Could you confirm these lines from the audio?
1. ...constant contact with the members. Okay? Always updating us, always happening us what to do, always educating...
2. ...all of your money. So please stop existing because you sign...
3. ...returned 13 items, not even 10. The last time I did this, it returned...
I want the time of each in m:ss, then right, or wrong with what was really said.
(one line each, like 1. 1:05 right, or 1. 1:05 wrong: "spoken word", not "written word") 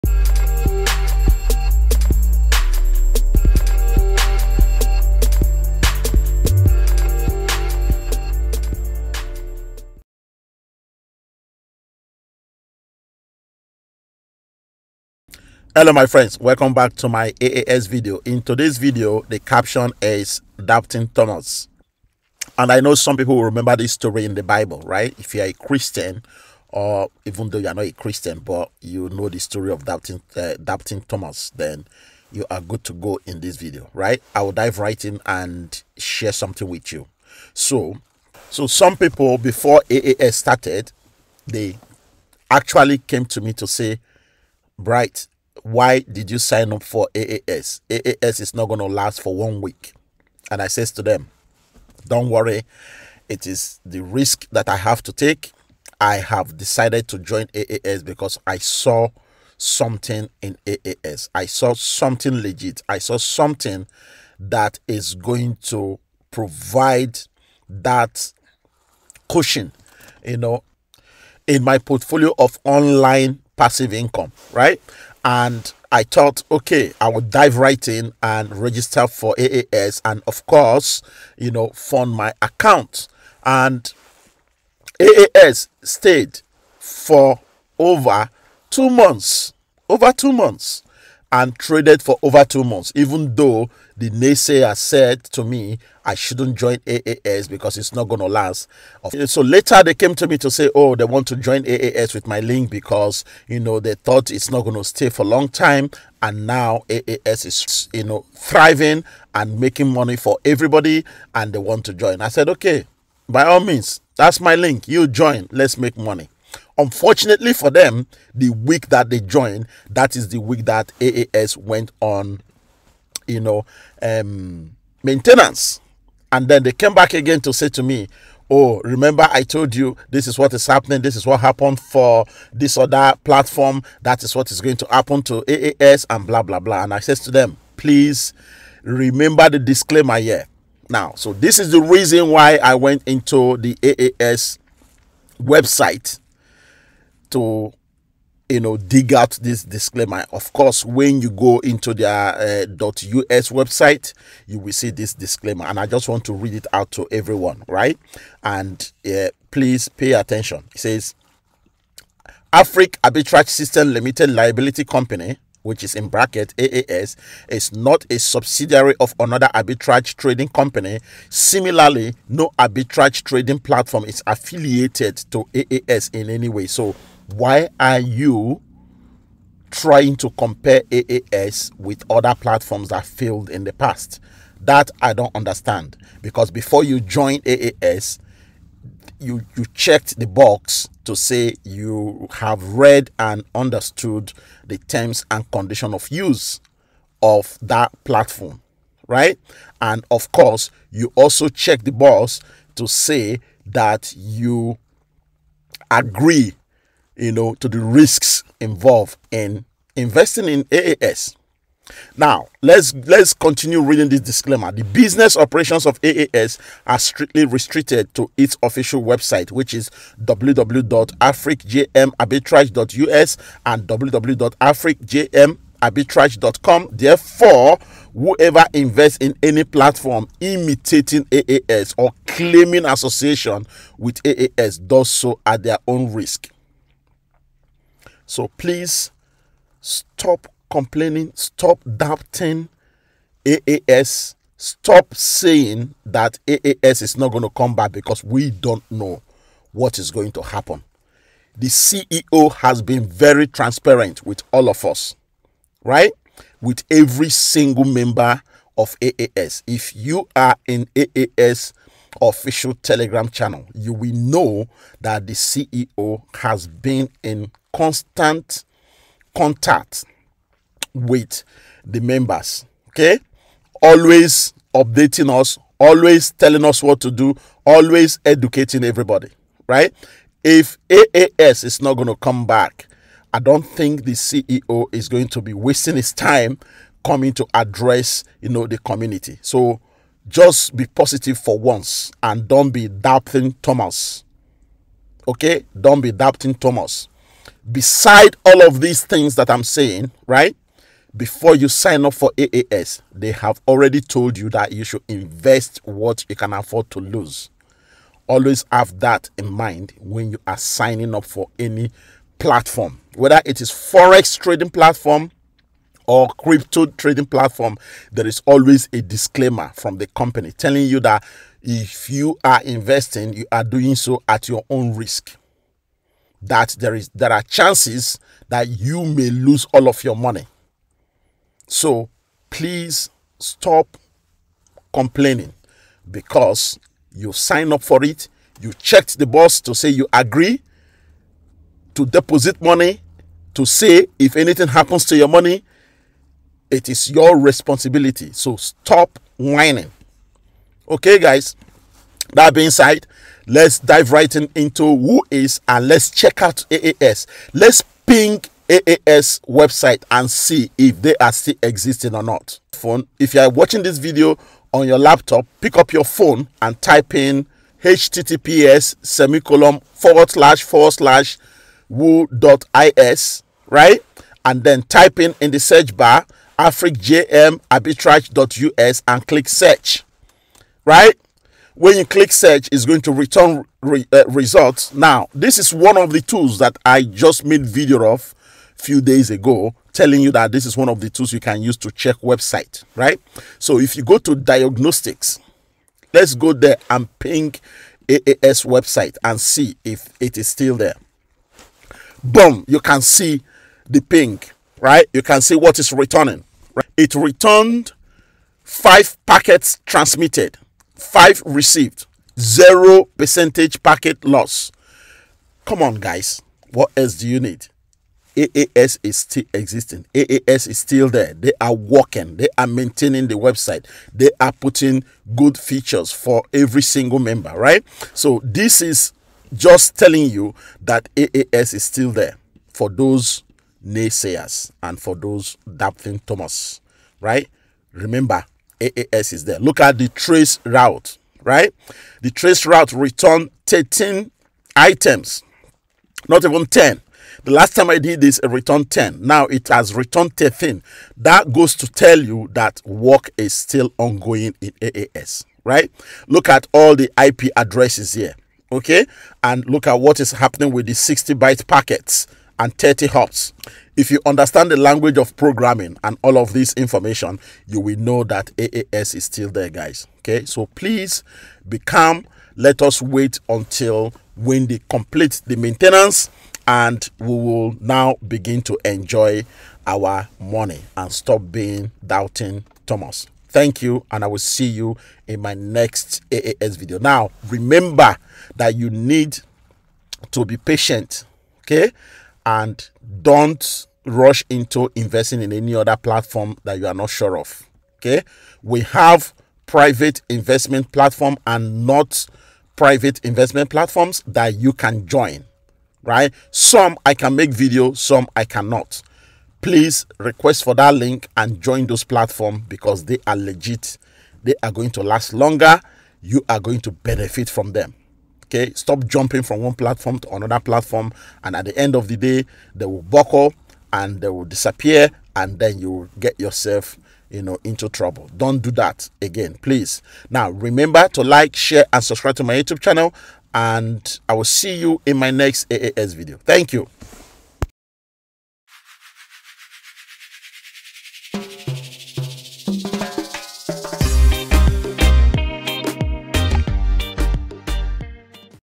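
1. 4:27 wrong: "telling", not "happening"
2. 5:29 wrong: "complaining", not "existing"
3. 7:22 right.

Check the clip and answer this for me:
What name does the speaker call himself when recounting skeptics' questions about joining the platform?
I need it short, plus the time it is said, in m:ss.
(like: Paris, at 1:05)
Bright, at 0:44.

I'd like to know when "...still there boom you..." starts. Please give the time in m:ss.
6:40.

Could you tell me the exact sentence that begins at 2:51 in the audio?
Similarly, no arbitrage trading platform is affiliated to AAS in any way.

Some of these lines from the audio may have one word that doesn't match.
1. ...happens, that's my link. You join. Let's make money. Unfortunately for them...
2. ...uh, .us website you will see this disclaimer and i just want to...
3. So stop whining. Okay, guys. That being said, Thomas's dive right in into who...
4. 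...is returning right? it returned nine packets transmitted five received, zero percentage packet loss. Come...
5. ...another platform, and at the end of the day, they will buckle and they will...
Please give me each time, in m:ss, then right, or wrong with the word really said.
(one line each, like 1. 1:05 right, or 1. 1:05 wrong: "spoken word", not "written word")
1. 1:53 wrong: "means", not "happens"
2. 2:32 right
3. 5:48 wrong: "Let", not "Thomas"
4. 6:45 wrong: "five", not "nine"
5. 8:40 right.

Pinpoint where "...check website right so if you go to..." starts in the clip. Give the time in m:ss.
6:31.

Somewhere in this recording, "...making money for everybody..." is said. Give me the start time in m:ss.
1:49.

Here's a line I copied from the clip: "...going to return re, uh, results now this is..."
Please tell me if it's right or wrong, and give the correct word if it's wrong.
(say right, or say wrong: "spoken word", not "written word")
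right.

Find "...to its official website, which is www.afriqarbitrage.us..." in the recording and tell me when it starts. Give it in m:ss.
3:38.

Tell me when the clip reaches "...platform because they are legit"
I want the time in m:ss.
8:32.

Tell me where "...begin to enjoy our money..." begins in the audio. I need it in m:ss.
7:58.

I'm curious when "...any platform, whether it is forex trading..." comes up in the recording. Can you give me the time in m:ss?
5:11.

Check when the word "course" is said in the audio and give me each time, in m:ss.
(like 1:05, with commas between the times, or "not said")
1:20, 2:30, 3:20.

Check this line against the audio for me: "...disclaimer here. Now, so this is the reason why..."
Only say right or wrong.
right.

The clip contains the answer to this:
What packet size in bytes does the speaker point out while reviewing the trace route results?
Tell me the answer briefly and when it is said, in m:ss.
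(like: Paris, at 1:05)
60, at 7:40.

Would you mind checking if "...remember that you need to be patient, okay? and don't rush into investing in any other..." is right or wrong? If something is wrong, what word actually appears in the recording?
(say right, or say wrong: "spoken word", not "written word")
right.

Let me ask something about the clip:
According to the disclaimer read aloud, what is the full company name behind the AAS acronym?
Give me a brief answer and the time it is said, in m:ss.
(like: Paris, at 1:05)
Afriq Arbitrage System, at 2:42.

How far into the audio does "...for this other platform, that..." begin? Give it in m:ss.
2:11.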